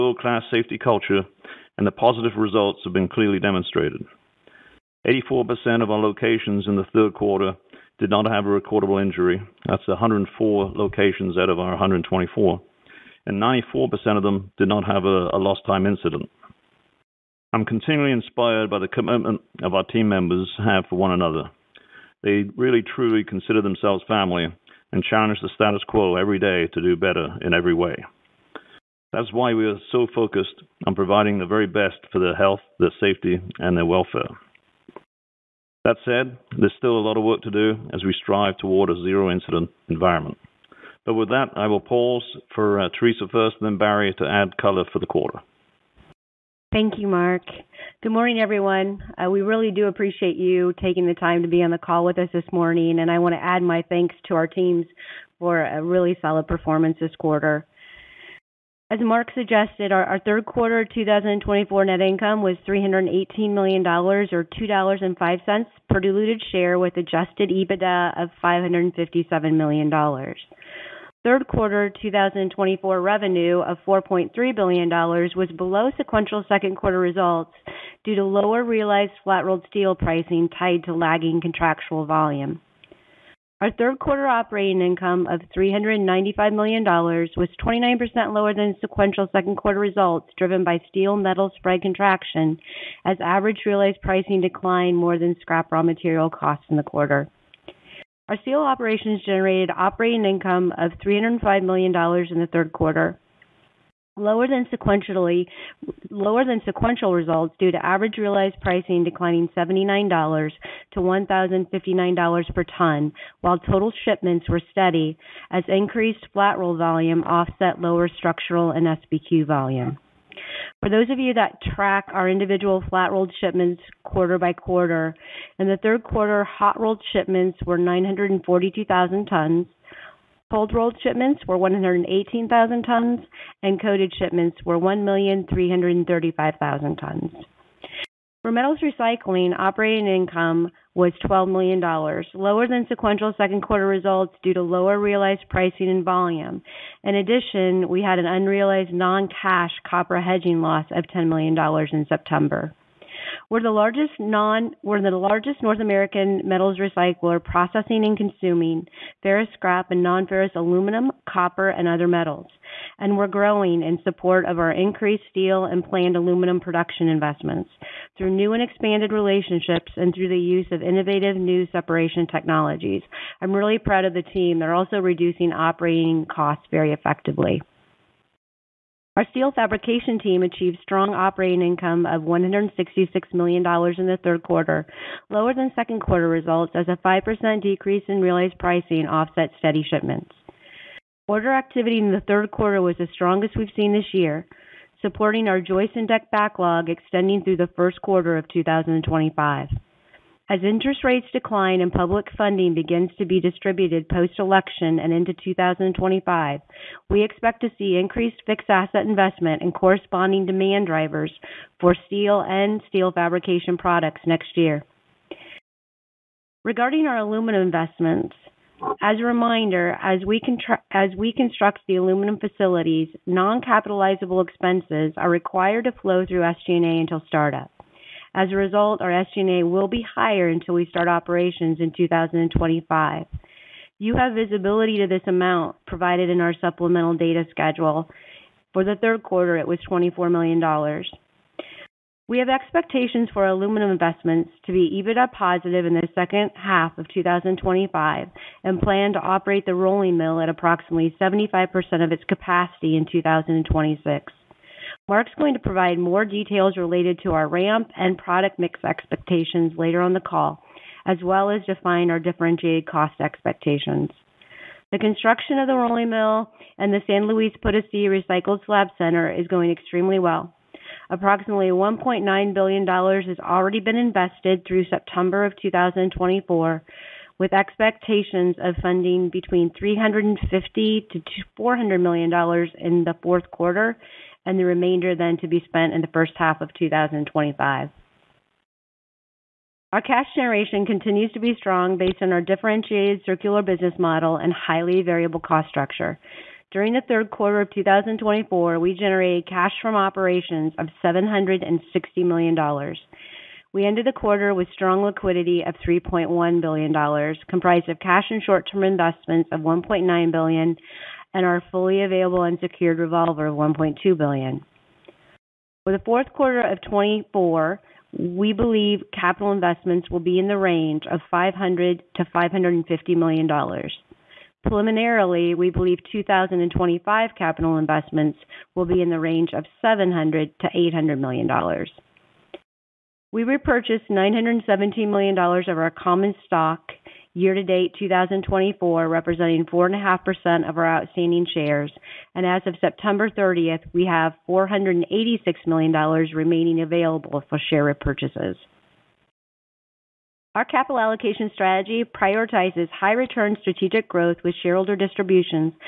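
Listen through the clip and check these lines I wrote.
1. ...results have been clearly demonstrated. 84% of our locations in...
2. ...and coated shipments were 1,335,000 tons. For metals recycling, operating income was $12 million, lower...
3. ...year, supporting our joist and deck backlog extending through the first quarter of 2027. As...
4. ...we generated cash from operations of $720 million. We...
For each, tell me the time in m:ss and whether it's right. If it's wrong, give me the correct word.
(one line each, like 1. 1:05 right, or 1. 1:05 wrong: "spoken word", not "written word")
1. 0:02 right
2. 2:13 right
3. 3:14 wrong: "2025", not "2027"
4. 4:58 wrong: "760", not "720".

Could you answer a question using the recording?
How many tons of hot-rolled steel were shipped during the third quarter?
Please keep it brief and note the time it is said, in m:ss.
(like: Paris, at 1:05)
942,000 tons, at 2:07.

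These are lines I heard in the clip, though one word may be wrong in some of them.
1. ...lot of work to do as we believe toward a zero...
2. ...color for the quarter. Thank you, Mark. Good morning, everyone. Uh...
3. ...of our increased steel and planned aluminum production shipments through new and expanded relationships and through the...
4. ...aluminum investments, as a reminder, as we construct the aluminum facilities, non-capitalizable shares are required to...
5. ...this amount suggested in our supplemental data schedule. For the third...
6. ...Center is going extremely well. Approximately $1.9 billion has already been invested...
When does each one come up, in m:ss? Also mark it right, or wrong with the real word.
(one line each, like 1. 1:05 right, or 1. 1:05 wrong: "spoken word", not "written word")
1. 0:37 wrong: "strive", not "believe"
2. 0:44 right
3. 2:44 wrong: "investments", not "shipments"
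4. 3:37 wrong: "expenses", not "shares"
5. 3:55 wrong: "provided", not "suggested"
6. 4:28 right.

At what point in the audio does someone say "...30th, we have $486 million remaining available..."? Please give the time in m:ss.
5:43.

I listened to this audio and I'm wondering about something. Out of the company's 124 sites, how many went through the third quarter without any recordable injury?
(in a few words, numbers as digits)
104.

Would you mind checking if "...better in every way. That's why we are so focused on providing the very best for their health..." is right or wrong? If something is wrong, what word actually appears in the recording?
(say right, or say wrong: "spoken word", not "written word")
right.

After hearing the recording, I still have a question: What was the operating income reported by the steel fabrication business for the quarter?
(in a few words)
$166 million.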